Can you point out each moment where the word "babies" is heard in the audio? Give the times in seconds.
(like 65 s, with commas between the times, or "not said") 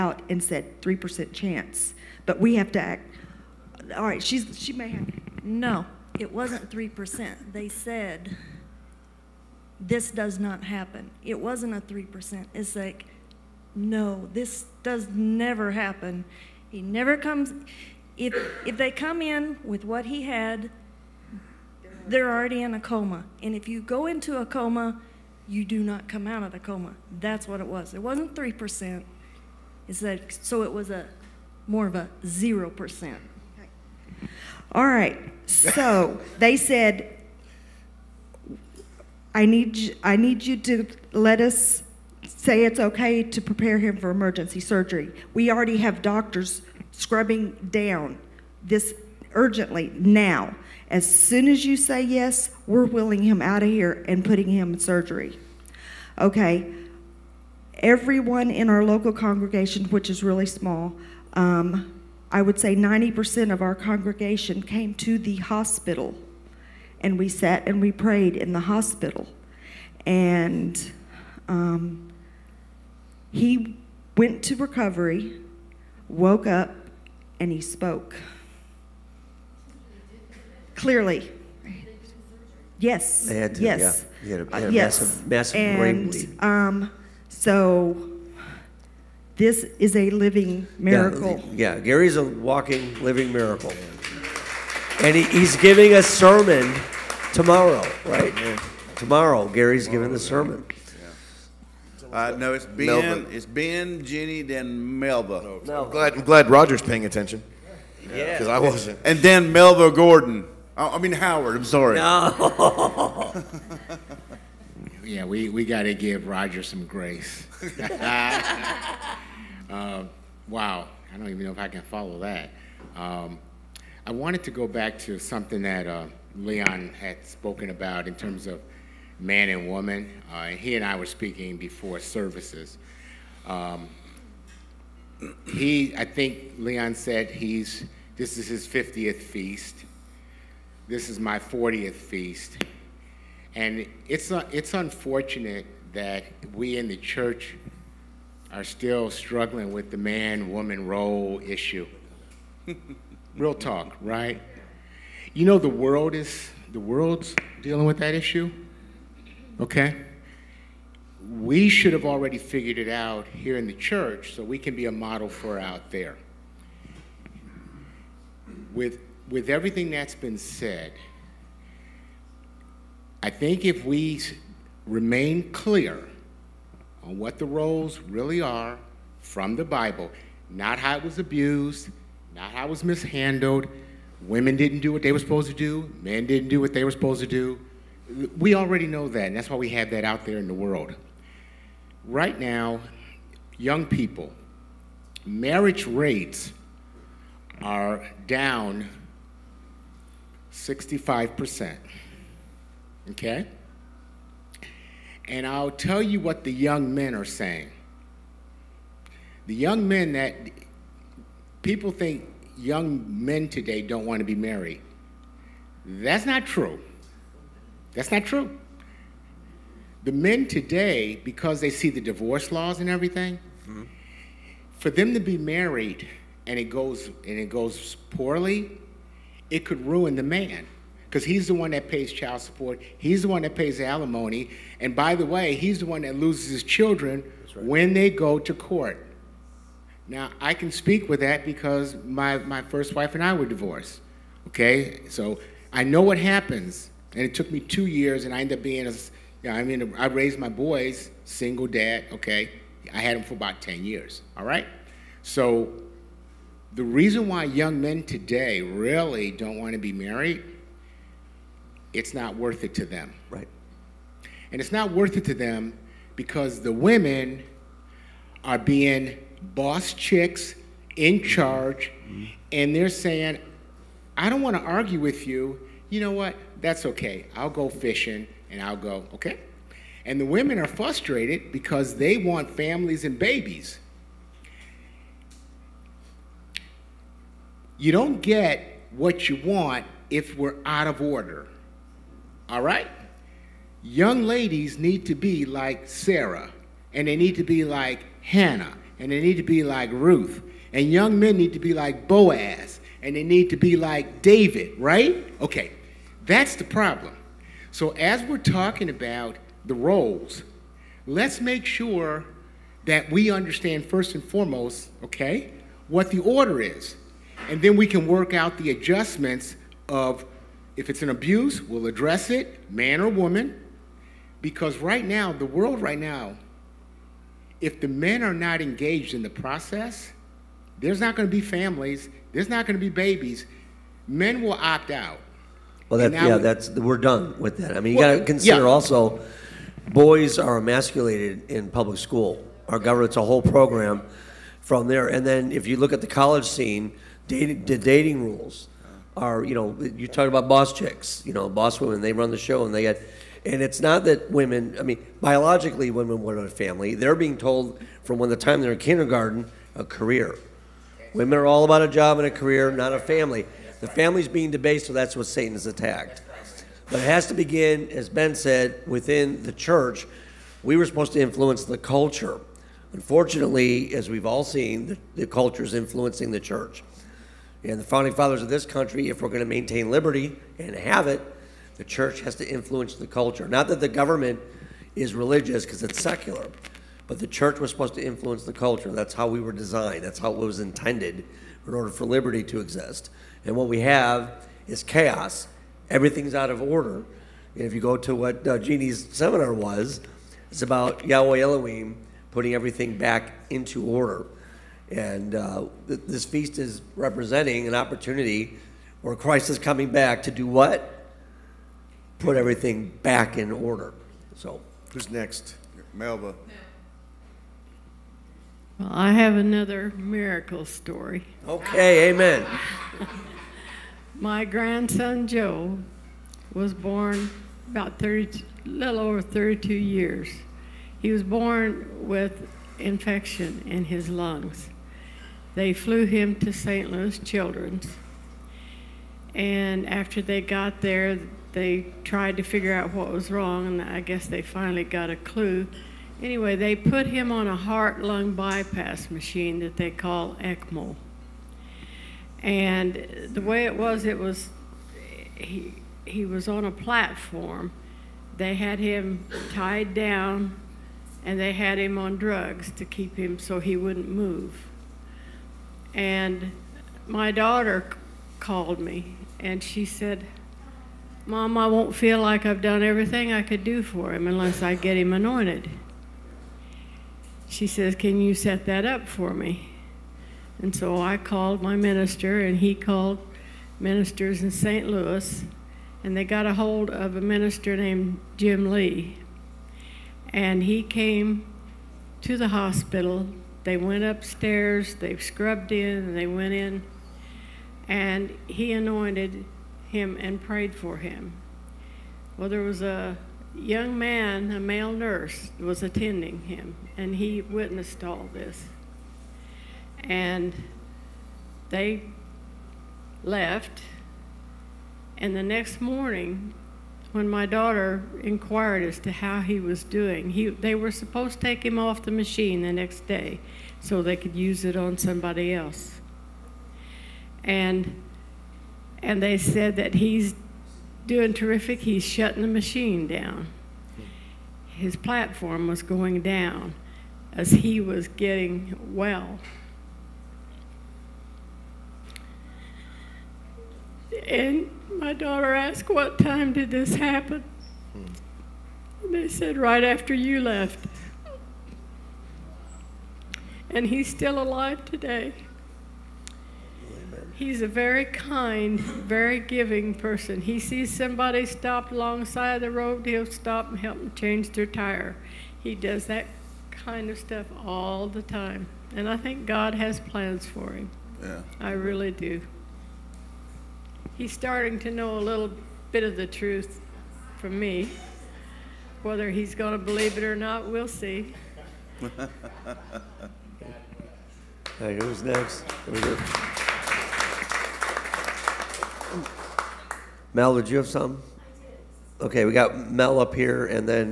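283 s, 332 s.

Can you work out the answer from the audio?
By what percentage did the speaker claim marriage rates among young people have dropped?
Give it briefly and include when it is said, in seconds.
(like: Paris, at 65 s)
65%, at 200 s.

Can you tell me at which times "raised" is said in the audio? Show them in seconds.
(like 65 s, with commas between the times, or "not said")
250 s.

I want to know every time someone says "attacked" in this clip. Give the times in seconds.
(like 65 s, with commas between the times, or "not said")
365 s.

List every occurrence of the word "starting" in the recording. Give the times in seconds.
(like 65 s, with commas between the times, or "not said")
574 s.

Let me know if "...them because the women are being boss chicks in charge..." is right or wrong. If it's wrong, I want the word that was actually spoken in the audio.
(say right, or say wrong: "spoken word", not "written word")
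right.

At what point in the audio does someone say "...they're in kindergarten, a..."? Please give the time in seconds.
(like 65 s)
358 s.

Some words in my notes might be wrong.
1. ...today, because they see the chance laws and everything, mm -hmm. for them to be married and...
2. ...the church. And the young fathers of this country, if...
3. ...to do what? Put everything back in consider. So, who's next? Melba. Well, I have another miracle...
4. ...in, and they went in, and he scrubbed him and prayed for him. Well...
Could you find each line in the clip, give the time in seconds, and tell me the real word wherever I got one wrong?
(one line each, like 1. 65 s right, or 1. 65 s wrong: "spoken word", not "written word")
1. 220 s wrong: "divorce", not "chance"
2. 376 s wrong: "founding", not "young"
3. 410 s wrong: "order", not "consider"
4. 495 s wrong: "anointed", not "scrubbed".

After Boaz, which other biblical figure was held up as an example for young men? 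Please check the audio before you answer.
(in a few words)
David.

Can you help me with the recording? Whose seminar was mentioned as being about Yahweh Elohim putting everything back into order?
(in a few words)
Jeannie.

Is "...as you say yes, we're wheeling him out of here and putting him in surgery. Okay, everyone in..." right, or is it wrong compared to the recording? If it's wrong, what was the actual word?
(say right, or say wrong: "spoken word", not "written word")
right.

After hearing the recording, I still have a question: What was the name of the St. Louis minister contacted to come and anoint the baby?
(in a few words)
Jim Lee.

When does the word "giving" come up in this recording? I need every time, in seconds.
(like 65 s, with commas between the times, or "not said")
95 s, 99 s, 559 s.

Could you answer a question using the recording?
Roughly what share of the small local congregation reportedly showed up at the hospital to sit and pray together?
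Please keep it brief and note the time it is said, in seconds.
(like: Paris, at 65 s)
90%, at 62 s.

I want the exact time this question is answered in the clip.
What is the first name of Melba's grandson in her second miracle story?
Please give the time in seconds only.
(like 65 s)
425 s.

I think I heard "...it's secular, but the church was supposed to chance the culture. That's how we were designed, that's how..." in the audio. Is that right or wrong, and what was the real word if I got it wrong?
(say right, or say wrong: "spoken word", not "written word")
wrong: "influence", not "chance".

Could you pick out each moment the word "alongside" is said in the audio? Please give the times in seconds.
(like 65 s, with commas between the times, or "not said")
561 s.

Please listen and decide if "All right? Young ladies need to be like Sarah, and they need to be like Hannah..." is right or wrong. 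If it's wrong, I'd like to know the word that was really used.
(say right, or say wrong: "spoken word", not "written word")
right.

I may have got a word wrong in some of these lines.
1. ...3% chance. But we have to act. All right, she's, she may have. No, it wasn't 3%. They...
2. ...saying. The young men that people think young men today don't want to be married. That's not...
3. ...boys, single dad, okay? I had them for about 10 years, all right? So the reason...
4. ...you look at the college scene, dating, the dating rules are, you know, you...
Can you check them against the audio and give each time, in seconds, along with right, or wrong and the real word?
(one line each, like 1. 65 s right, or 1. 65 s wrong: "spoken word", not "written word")
1. 0 s right
2. 207 s right
3. 250 s right
4. 345 s right.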